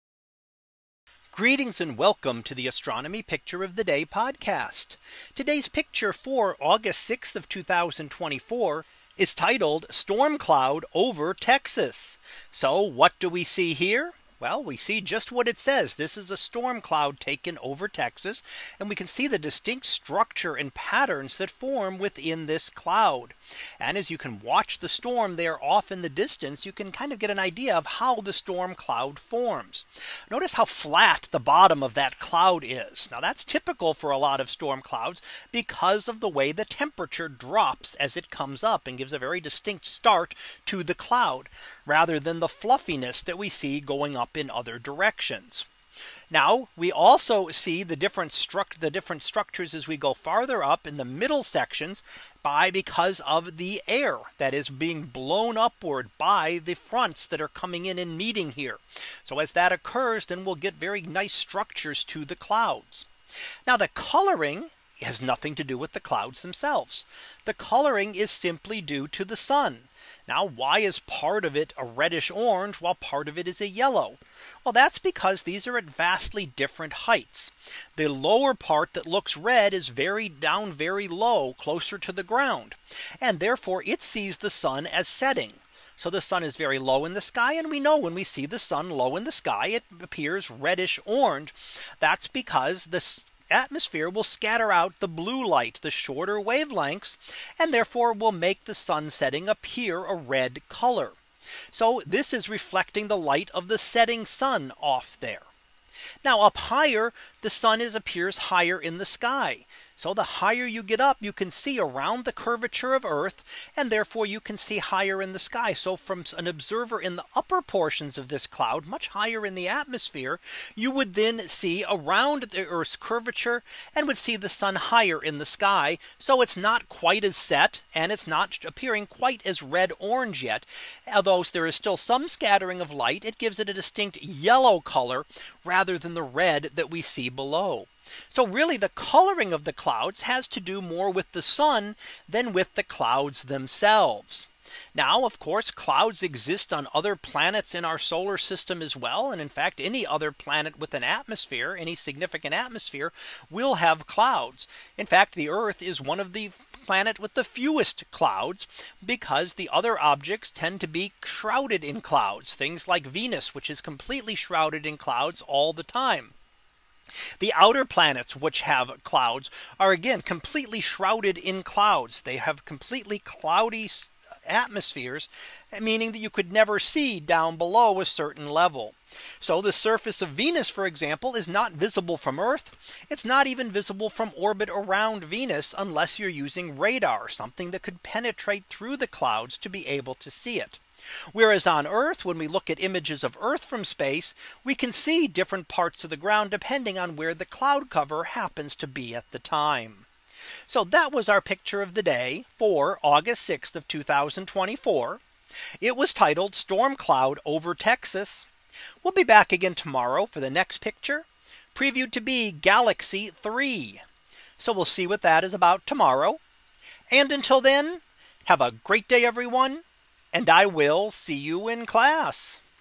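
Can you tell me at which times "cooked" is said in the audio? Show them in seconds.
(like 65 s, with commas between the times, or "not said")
not said.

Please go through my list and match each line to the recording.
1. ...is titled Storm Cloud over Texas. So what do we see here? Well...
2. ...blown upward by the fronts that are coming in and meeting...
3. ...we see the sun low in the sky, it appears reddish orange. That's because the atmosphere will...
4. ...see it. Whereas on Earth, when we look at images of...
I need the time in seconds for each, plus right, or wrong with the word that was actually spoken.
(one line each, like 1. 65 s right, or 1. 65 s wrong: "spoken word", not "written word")
1. 9 s right
2. 55 s right
3. 88 s right
4. 190 s right.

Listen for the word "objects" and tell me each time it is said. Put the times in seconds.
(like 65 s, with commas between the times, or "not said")
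159 s.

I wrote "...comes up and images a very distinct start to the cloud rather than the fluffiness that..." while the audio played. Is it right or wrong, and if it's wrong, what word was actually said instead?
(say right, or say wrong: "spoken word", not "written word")
wrong: "gives", not "images".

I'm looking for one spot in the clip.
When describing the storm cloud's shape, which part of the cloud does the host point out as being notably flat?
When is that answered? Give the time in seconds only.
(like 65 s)
31 s.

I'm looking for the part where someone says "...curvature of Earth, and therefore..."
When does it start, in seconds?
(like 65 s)
112 s.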